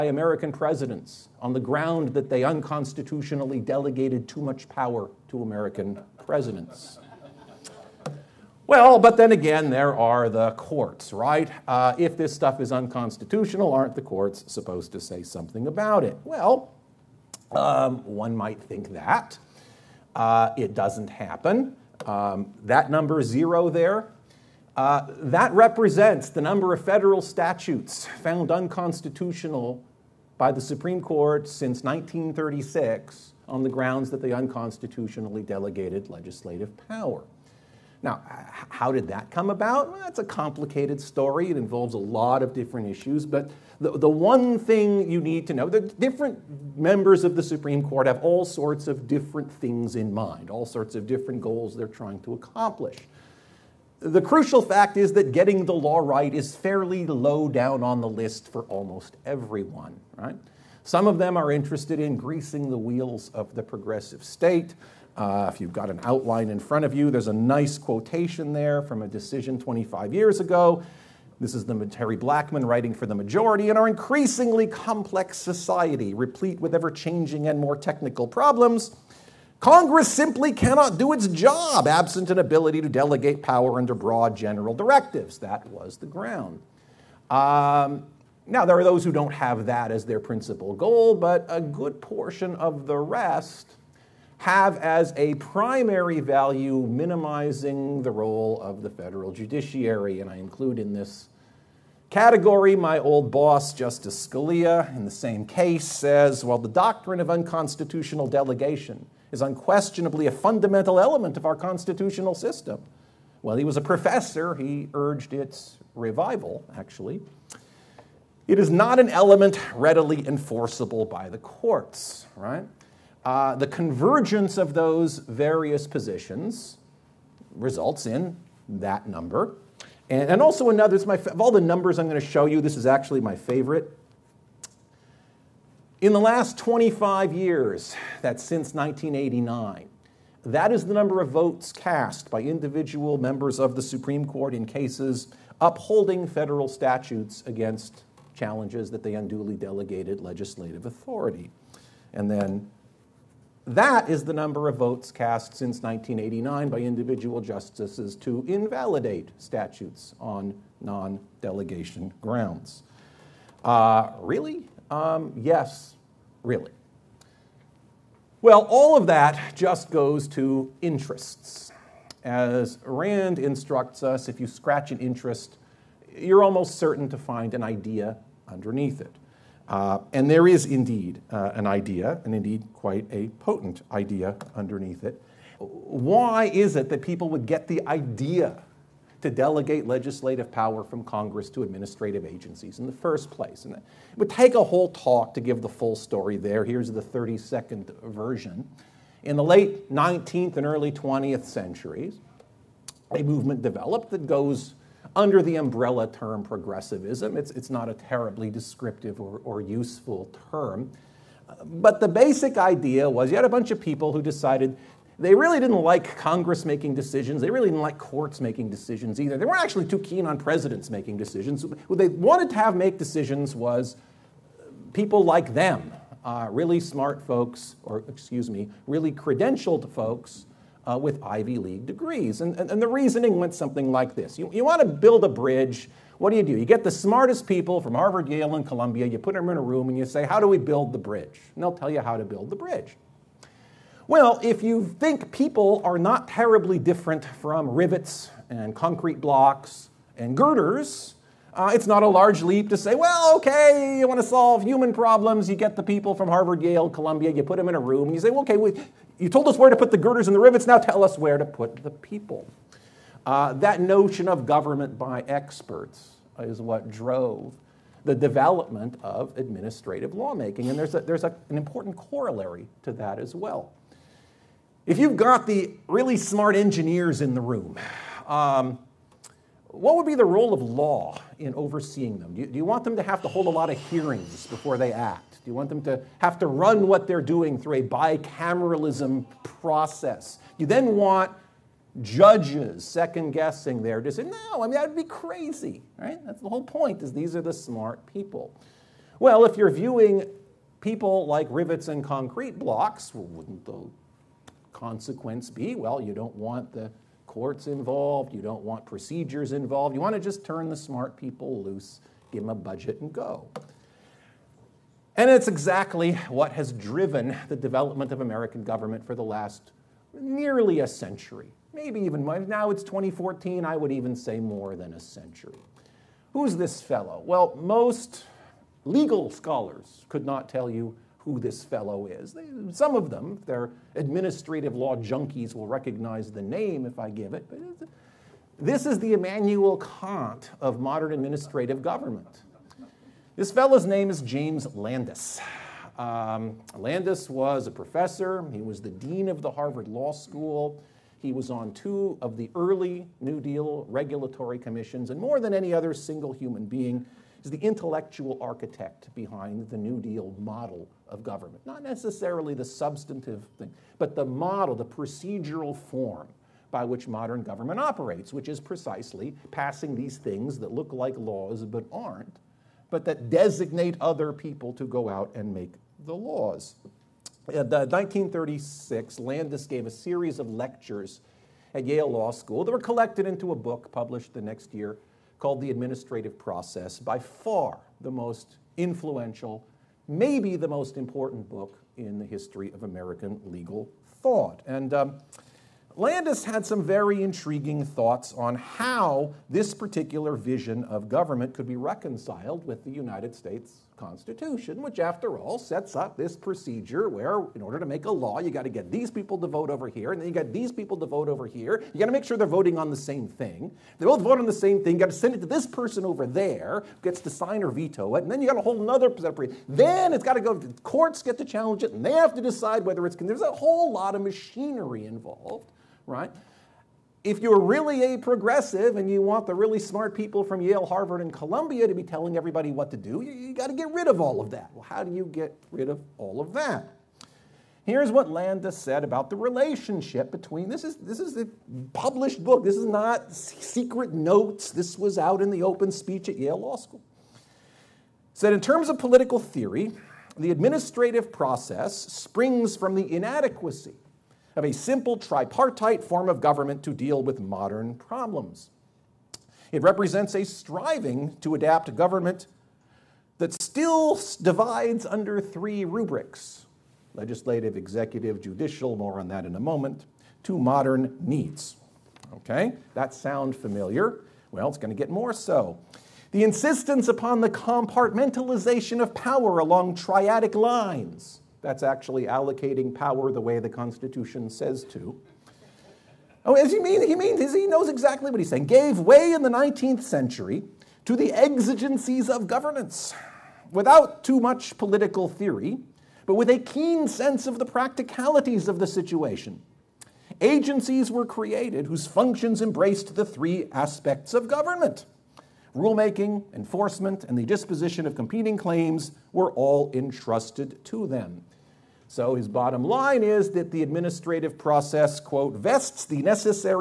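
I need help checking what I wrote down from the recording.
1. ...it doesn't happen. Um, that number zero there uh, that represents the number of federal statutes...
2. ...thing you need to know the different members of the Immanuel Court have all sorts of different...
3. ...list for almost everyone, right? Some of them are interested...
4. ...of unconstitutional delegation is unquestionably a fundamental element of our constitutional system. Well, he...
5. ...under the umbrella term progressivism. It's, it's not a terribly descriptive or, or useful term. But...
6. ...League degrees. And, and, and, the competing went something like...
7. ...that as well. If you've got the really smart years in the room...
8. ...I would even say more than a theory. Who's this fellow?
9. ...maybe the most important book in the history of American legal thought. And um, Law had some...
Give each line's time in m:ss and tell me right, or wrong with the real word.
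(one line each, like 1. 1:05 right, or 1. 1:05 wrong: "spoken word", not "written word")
1. 0:20 right
2. 0:44 wrong: "Supreme", not "Immanuel"
3. 0:58 right
4. 1:47 right
5. 3:25 right
6. 3:51 wrong: "reasoning", not "competing"
7. 4:32 wrong: "engineers", not "years"
8. 5:23 wrong: "century", not "theory"
9. 6:30 wrong: "Landis", not "Law".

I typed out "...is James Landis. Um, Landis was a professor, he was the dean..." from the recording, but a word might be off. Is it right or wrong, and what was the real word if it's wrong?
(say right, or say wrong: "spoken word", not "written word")
right.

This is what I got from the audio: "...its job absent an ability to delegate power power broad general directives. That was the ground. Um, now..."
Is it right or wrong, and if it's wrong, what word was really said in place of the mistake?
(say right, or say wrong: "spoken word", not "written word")
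wrong: "under", not "power".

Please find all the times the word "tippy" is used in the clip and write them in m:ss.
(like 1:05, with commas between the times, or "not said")
not said.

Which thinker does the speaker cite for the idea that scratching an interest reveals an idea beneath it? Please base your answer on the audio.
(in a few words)
Rand.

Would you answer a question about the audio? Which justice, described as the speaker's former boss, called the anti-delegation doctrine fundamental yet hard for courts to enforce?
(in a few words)
Justice Scalia.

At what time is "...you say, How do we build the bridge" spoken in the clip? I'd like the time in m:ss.
3:59.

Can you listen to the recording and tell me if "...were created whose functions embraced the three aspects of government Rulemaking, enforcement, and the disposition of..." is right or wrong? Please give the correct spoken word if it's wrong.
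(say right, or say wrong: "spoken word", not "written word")
right.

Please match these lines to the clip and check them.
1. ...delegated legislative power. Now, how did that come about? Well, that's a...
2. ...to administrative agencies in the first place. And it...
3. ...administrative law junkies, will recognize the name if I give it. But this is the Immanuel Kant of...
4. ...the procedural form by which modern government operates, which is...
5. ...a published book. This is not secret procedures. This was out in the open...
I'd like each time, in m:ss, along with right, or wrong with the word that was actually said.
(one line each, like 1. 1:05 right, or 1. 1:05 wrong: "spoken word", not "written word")
1. 0:35 right
2. 3:11 right
3. 5:33 right
4. 6:04 right
5. 7:21 wrong: "notes", not "procedures".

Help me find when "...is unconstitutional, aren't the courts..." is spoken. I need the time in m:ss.
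0:12.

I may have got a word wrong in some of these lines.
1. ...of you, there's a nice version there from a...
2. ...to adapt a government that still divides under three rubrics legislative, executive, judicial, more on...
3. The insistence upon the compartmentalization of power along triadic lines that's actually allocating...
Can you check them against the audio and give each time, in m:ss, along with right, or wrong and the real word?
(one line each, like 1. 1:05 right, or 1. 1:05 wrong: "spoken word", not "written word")
1. 1:06 wrong: "quotation", not "version"
2. 7:41 right
3. 7:56 right.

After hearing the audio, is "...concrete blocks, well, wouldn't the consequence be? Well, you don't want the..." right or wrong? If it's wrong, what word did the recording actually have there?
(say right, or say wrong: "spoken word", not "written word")
right.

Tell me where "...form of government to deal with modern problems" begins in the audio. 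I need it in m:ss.
7:36.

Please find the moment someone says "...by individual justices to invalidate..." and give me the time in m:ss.
2:36.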